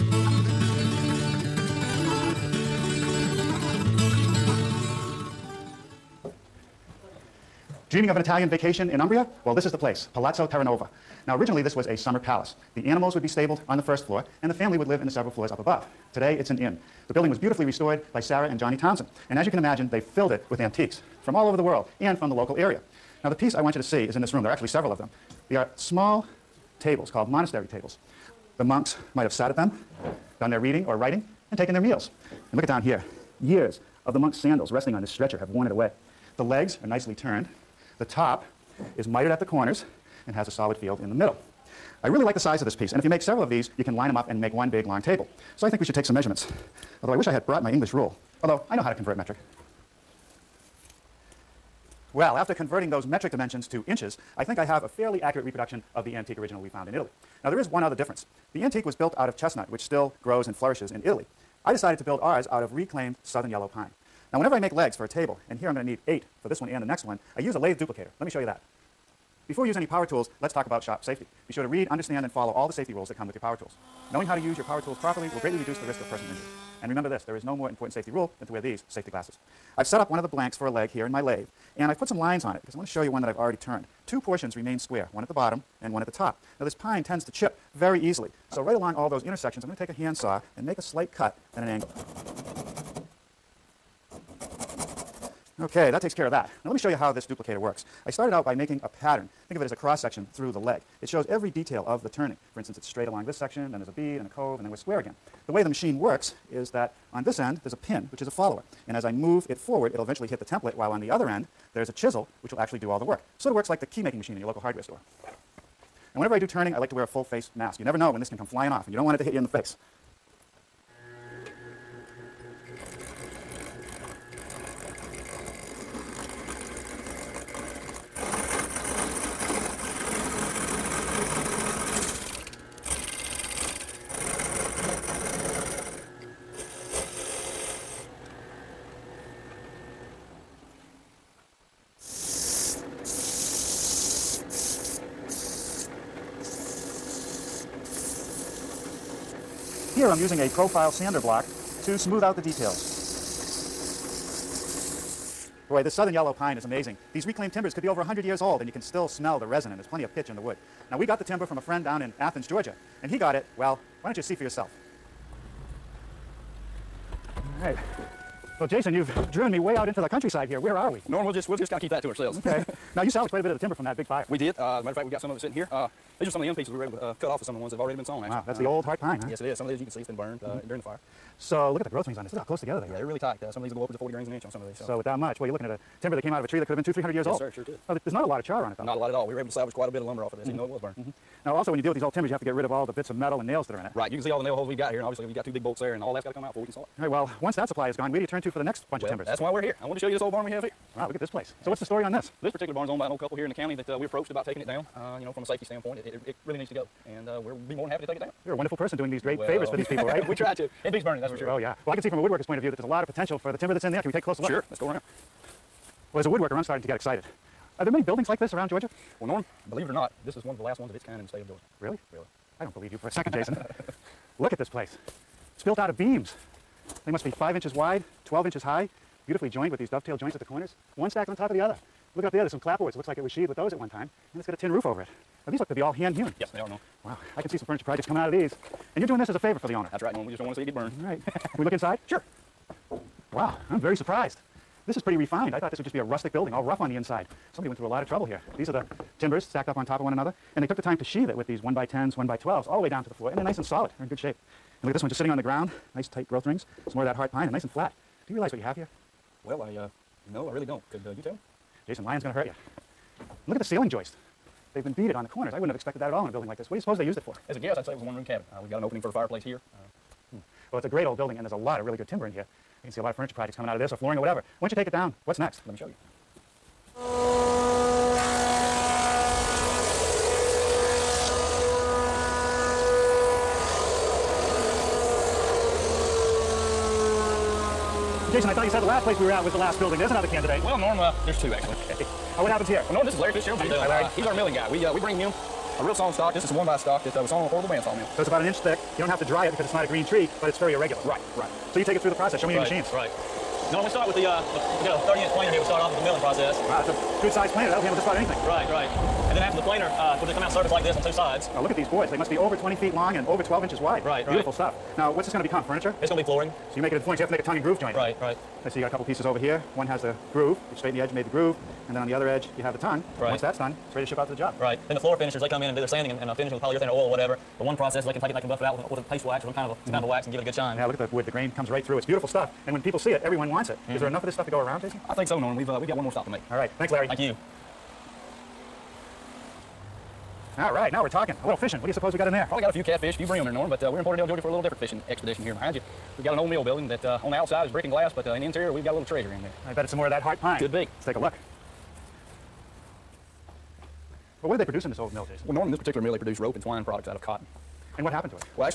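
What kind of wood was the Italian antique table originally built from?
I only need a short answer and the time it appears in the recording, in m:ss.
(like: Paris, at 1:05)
Chestnut, at 0:59.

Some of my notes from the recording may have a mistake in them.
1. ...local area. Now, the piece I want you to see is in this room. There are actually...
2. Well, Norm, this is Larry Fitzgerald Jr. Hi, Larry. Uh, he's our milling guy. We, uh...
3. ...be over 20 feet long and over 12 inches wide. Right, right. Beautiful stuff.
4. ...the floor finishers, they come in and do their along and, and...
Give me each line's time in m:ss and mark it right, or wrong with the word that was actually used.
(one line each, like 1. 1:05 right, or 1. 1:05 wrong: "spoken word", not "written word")
1. 0:22 right
2. 4:52 right
3. 5:12 right
4. 5:24 wrong: "sanding", not "along".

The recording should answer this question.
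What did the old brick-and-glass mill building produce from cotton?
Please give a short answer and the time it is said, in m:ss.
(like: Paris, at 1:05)
Rope and twine, at 5:56.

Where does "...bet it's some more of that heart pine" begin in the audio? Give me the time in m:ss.
5:49.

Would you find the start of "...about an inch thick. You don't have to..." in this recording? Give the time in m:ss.
4:58.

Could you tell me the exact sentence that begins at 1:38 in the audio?
I started out by making a pattern.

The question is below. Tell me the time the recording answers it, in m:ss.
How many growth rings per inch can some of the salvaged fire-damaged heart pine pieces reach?
3:03.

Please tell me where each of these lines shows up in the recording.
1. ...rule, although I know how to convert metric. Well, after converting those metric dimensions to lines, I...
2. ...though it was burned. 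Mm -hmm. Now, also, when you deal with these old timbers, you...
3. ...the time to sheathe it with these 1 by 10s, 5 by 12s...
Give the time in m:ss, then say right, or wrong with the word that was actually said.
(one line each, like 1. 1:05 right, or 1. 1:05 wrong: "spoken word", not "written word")
1. 0:47 wrong: "inches", not "lines"
2. 3:10 right
3. 4:10 wrong: "1", not "5".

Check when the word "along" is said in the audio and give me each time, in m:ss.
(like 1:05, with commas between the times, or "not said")
1:28, 1:43.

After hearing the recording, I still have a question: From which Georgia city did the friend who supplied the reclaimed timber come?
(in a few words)
Athens.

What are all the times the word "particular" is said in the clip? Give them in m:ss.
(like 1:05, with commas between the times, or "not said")
3:22, 5:55.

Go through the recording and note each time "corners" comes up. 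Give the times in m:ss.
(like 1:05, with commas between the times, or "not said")
0:39, 3:50, 4:25.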